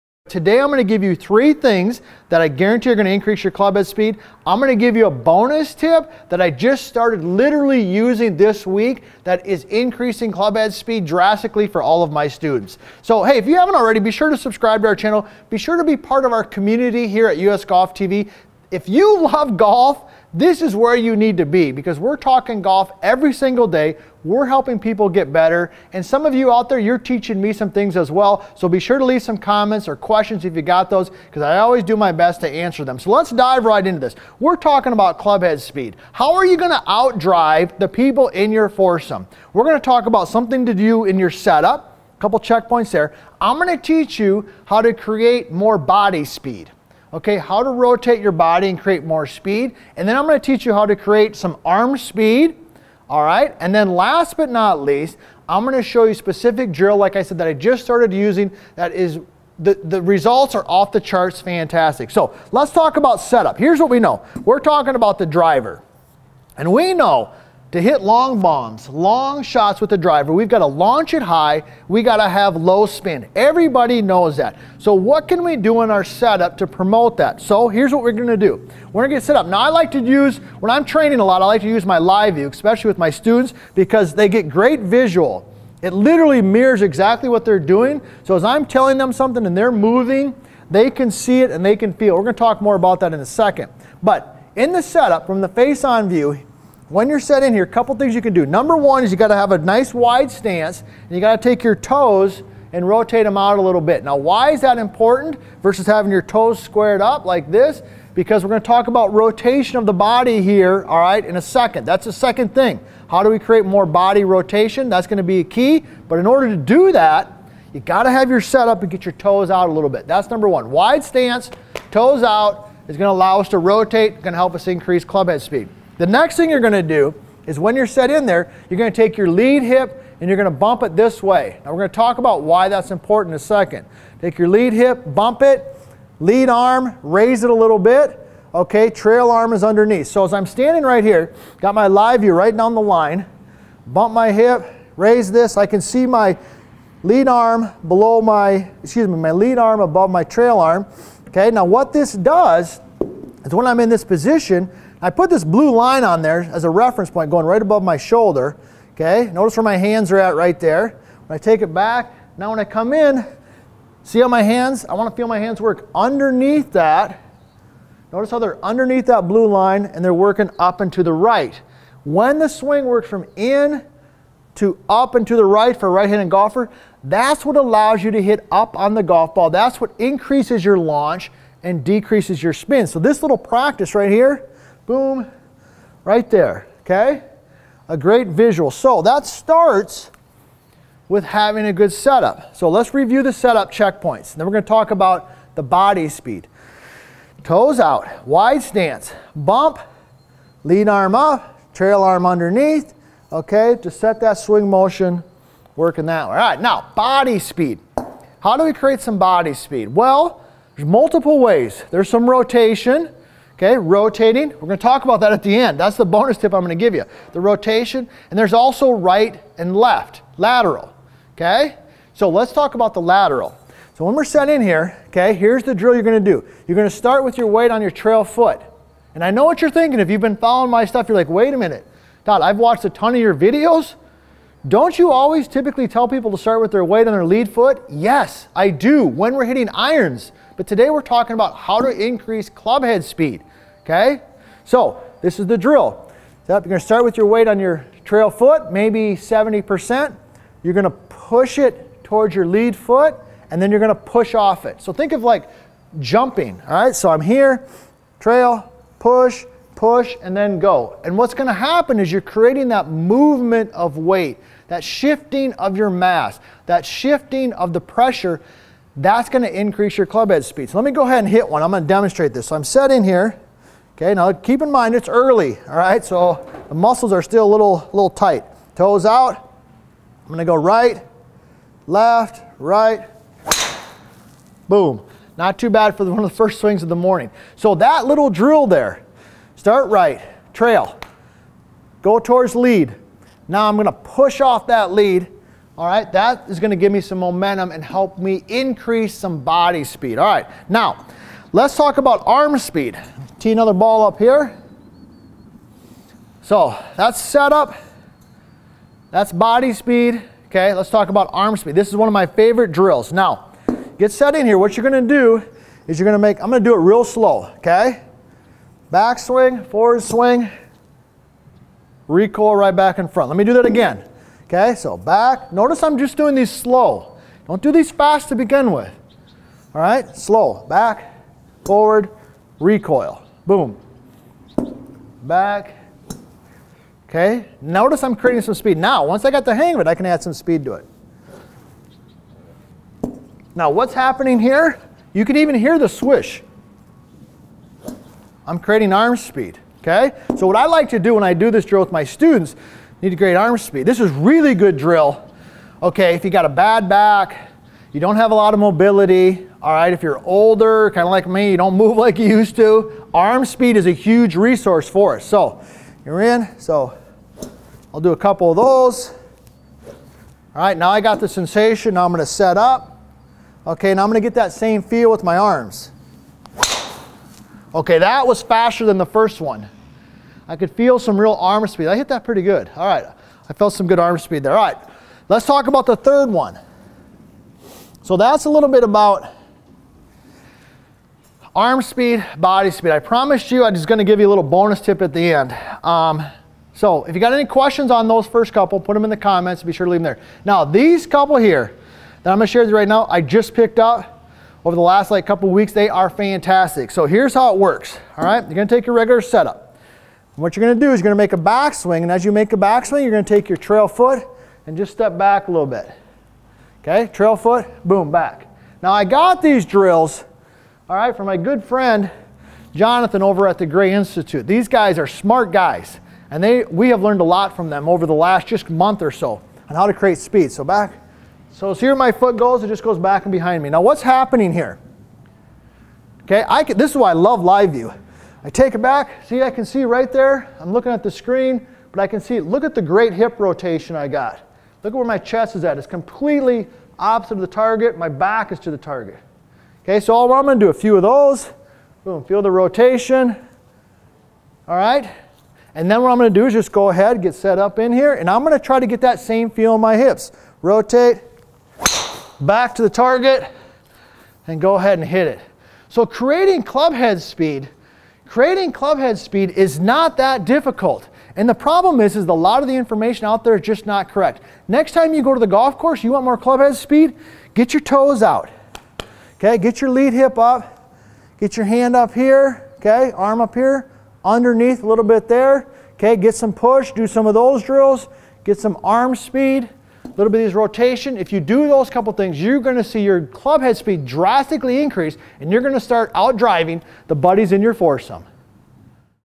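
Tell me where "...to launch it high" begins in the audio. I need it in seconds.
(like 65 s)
70 s.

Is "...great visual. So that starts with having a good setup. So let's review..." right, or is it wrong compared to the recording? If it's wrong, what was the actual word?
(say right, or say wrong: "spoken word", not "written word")
right.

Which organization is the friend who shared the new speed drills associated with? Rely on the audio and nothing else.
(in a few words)
Gray Institute.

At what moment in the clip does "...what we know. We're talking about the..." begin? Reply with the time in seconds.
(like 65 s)
63 s.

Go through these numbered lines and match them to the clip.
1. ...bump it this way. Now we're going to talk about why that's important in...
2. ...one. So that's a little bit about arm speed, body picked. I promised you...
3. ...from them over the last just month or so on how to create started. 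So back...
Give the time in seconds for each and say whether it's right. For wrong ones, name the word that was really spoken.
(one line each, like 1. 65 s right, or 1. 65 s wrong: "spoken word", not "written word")
1. 130 s right
2. 386 s wrong: "speed", not "picked"
3. 427 s wrong: "speed", not "started".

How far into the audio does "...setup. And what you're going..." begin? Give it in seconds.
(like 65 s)
409 s.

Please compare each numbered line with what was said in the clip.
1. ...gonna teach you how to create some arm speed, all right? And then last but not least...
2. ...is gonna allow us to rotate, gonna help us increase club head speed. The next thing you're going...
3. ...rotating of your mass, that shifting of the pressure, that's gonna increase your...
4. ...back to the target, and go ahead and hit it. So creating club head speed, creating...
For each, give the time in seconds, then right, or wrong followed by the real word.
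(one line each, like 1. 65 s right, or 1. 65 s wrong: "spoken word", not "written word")
1. 50 s right
2. 122 s right
3. 264 s wrong: "shifting", not "rotating"
4. 462 s right.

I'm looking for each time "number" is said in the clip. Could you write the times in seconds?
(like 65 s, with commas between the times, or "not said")
98 s, 120 s.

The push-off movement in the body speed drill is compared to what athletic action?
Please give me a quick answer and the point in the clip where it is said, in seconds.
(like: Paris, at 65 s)
Jumping, at 255 s.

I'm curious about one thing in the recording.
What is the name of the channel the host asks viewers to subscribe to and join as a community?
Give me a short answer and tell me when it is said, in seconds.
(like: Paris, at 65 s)
US Golf TV, at 17 s.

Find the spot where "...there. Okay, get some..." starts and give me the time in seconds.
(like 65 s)
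485 s.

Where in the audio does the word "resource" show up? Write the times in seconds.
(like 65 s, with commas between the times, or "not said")
364 s.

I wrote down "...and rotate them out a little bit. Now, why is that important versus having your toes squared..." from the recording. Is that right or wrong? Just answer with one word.
right.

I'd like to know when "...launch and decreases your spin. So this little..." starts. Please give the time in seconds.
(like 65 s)
180 s.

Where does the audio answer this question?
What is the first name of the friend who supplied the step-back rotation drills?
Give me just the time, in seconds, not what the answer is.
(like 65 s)
422 s.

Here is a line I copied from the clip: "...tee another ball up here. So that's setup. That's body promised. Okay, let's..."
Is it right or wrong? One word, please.
wrong.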